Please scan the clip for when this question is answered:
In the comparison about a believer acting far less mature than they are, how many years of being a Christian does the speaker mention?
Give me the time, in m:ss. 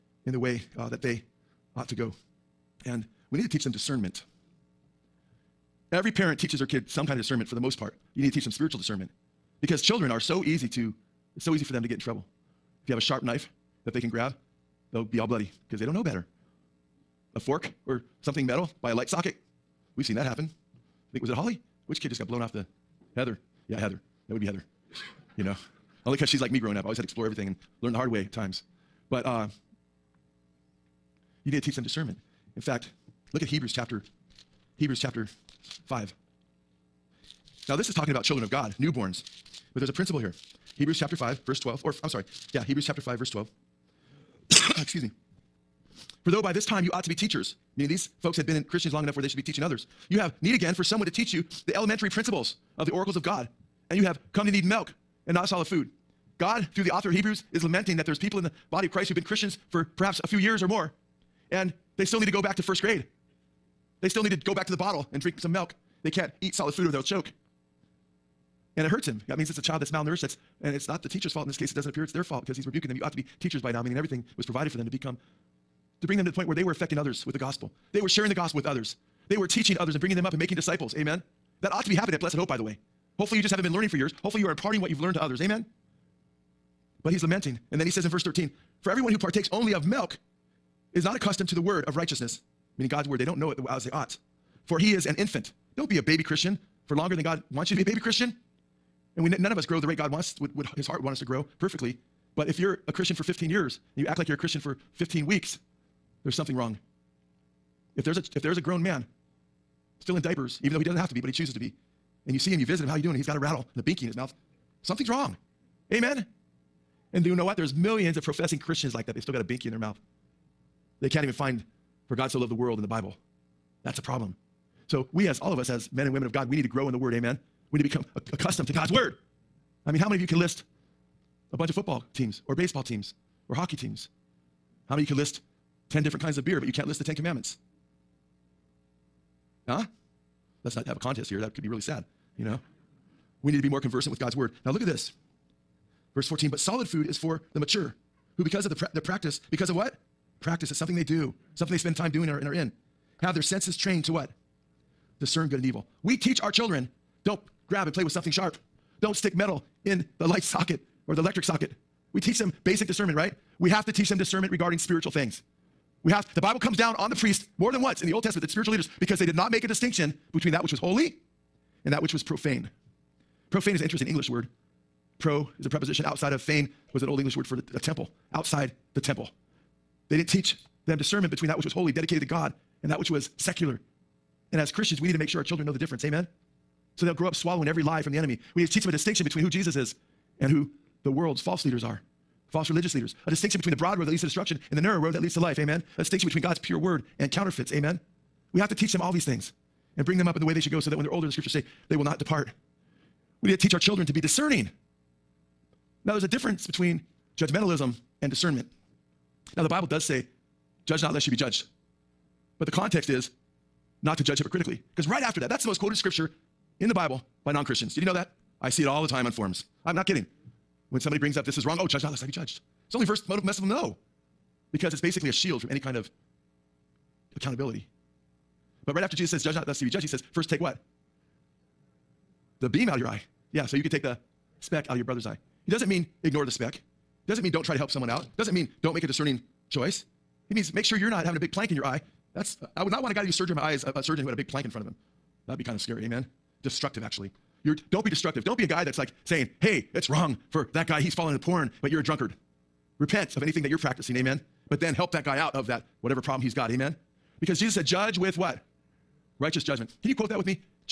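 1:43.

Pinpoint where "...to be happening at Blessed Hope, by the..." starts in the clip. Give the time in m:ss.
1:21.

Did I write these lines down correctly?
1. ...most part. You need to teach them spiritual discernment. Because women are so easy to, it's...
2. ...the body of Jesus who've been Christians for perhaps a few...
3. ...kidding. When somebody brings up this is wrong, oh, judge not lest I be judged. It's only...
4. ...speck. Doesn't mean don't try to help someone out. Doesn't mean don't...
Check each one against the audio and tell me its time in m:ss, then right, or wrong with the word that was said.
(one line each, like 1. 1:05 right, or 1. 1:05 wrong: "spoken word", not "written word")
1. 0:07 wrong: "children", not "women"
2. 0:58 wrong: "Christ", not "Jesus"
3. 3:40 right
4. 3:56 right.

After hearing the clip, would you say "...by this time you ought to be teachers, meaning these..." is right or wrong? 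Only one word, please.
right.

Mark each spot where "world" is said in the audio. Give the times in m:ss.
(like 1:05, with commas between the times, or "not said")
2:02, 3:11.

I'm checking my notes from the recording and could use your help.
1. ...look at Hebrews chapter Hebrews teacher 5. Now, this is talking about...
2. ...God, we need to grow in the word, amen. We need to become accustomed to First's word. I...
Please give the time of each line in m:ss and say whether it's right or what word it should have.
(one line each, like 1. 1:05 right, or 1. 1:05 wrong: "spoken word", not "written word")
1. 0:33 wrong: "chapter", not "teacher"
2. 2:06 wrong: "God", not "First".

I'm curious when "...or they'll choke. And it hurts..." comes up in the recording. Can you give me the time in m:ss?
1:06.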